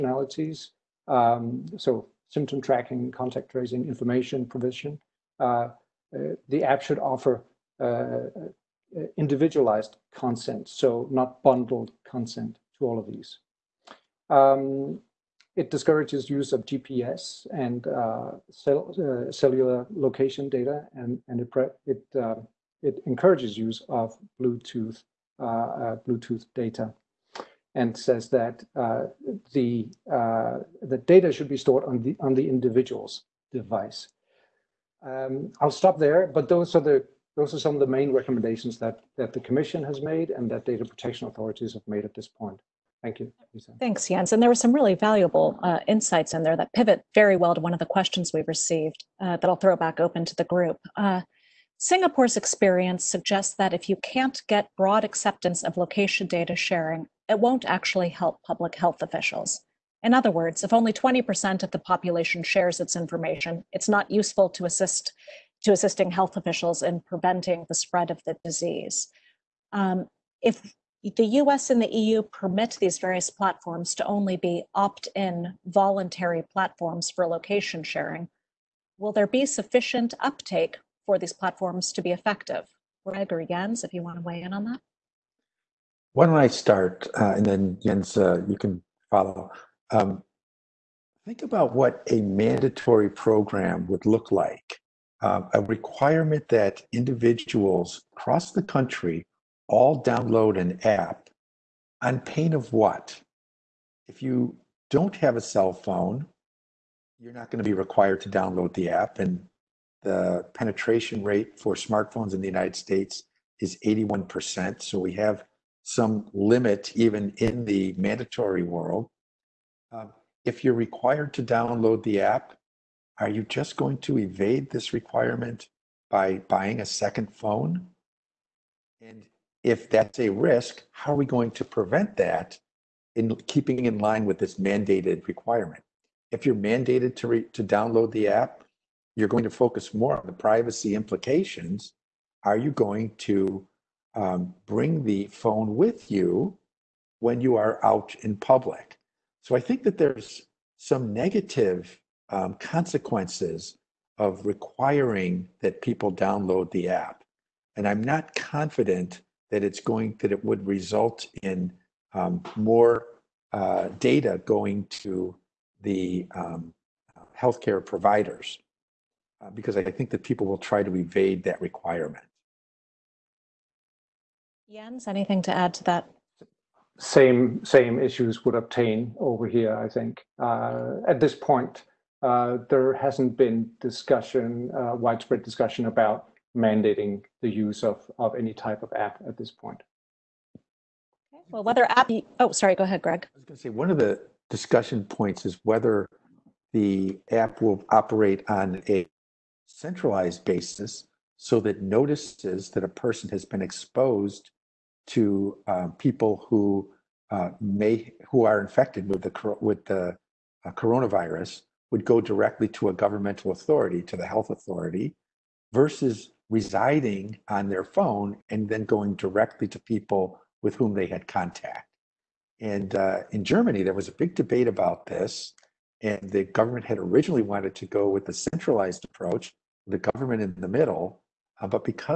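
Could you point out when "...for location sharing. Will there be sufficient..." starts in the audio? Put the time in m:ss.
1:17.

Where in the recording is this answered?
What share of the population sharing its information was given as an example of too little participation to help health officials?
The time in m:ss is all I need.
1:00.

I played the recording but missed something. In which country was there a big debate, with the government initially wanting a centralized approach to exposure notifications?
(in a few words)
Germany.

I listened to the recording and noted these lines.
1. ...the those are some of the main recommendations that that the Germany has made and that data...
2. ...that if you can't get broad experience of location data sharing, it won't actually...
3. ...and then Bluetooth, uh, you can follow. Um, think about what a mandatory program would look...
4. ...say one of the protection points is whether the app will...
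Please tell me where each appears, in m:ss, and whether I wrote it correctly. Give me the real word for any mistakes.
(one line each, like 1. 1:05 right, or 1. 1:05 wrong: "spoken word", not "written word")
1. 0:36 wrong: "Commission", not "Germany"
2. 0:53 wrong: "acceptance", not "experience"
3. 1:27 wrong: "Jens", not "Bluetooth"
4. 3:13 wrong: "discussion", not "protection".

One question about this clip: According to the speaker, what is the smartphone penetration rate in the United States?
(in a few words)
81%.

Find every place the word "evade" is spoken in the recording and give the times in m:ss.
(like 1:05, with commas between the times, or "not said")
2:04, 2:50.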